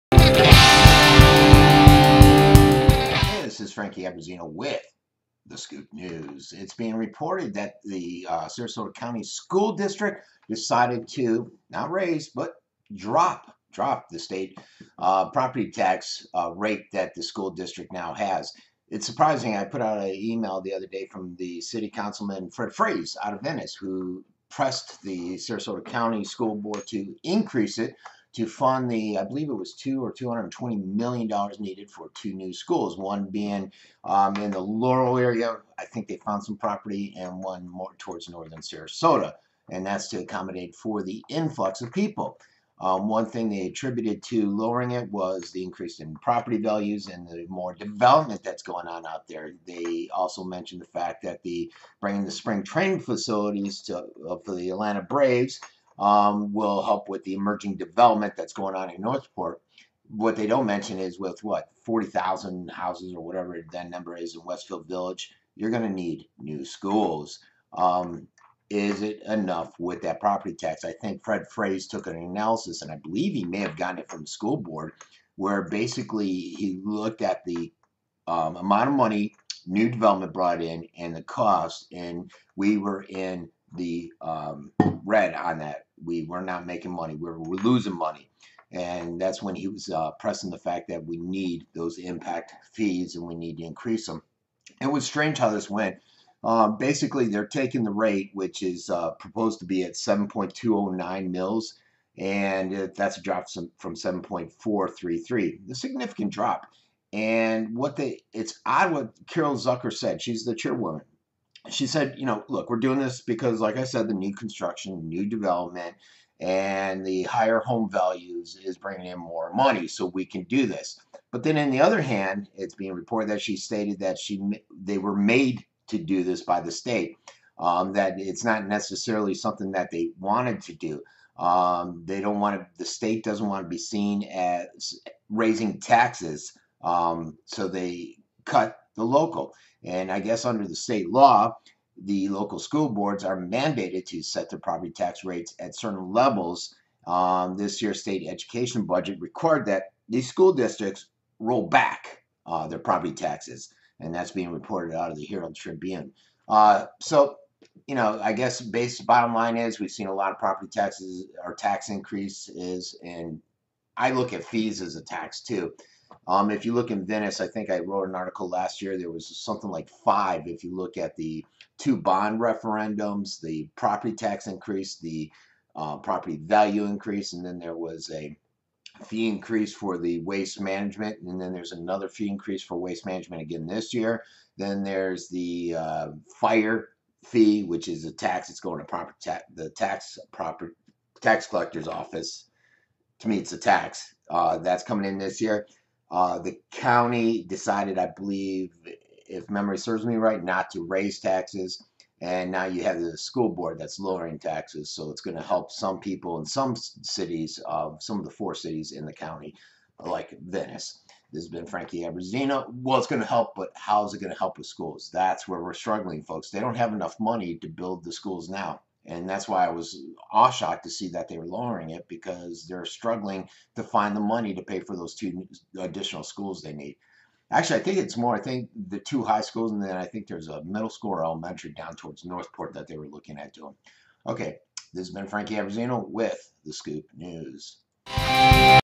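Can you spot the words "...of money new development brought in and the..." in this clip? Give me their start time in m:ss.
1:18.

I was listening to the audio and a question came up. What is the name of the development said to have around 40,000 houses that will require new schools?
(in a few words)
Westfield Village.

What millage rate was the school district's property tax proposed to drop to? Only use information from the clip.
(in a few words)
7.209 mills.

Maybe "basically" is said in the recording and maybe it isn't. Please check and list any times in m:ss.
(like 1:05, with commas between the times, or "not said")
1:15, 1:36.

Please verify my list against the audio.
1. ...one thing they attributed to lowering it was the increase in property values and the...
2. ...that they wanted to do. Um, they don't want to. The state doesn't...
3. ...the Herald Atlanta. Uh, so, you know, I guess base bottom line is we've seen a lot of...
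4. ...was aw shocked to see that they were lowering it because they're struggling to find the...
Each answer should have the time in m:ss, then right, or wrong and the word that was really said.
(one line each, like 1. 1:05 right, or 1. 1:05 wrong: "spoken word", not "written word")
1. 0:43 right
2. 2:09 right
3. 2:35 wrong: "Tribune", not "Atlanta"
4. 3:39 right.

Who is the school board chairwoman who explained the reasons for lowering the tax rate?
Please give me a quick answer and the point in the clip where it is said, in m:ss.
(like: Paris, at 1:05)
Carol Zucker, at 1:49.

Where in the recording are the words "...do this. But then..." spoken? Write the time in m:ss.
2:00.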